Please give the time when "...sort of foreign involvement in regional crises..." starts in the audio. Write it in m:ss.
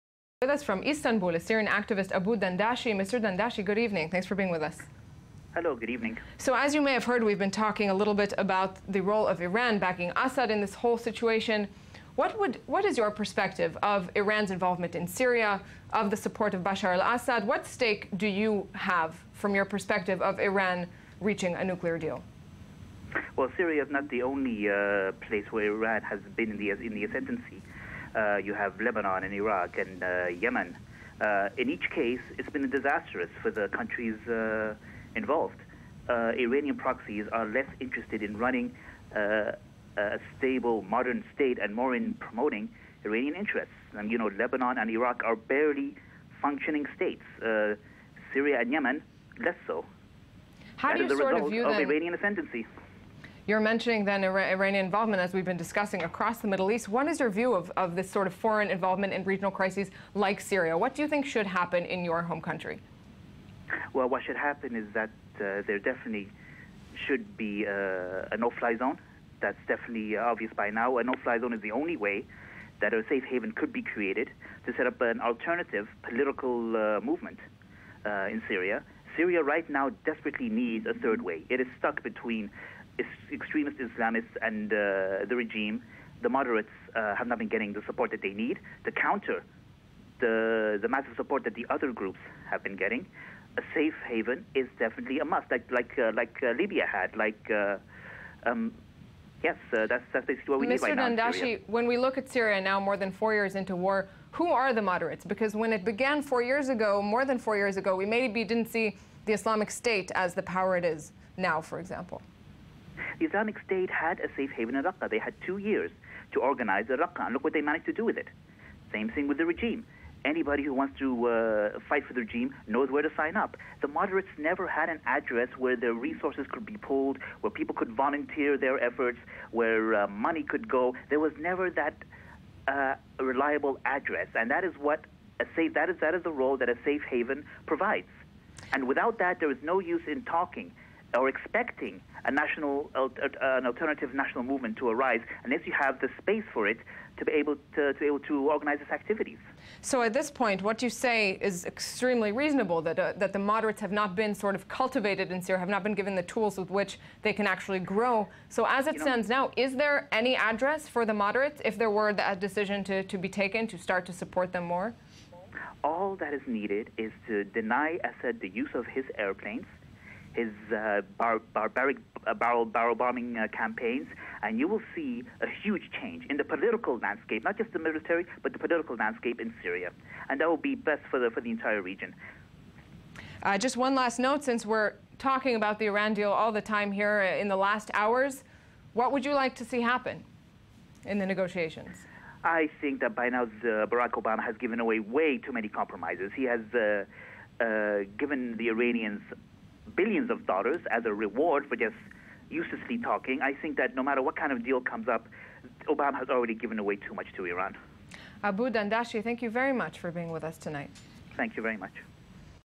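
0:58.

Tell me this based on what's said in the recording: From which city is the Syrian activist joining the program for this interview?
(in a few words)
Istanbul.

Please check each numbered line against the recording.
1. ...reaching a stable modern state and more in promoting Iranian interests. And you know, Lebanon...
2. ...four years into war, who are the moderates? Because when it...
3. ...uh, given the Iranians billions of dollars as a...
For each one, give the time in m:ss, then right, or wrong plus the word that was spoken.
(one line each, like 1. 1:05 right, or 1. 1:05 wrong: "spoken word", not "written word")
1. 0:38 wrong: "running", not "reaching"
2. 1:43 right
3. 3:17 right.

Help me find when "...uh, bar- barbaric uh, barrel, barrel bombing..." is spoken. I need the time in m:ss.
2:50.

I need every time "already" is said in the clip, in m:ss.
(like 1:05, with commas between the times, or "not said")
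3:26.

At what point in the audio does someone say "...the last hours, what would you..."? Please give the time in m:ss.
3:07.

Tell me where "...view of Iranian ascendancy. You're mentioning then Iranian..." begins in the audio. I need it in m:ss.
0:51.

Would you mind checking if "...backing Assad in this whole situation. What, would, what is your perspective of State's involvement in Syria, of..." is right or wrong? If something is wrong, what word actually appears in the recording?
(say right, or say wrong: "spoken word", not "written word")
wrong: "Iran", not "State".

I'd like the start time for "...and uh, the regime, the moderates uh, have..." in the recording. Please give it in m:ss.
1:24.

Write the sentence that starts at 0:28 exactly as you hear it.
Uh, you have Lebanon and Iraq and uh, Yemen.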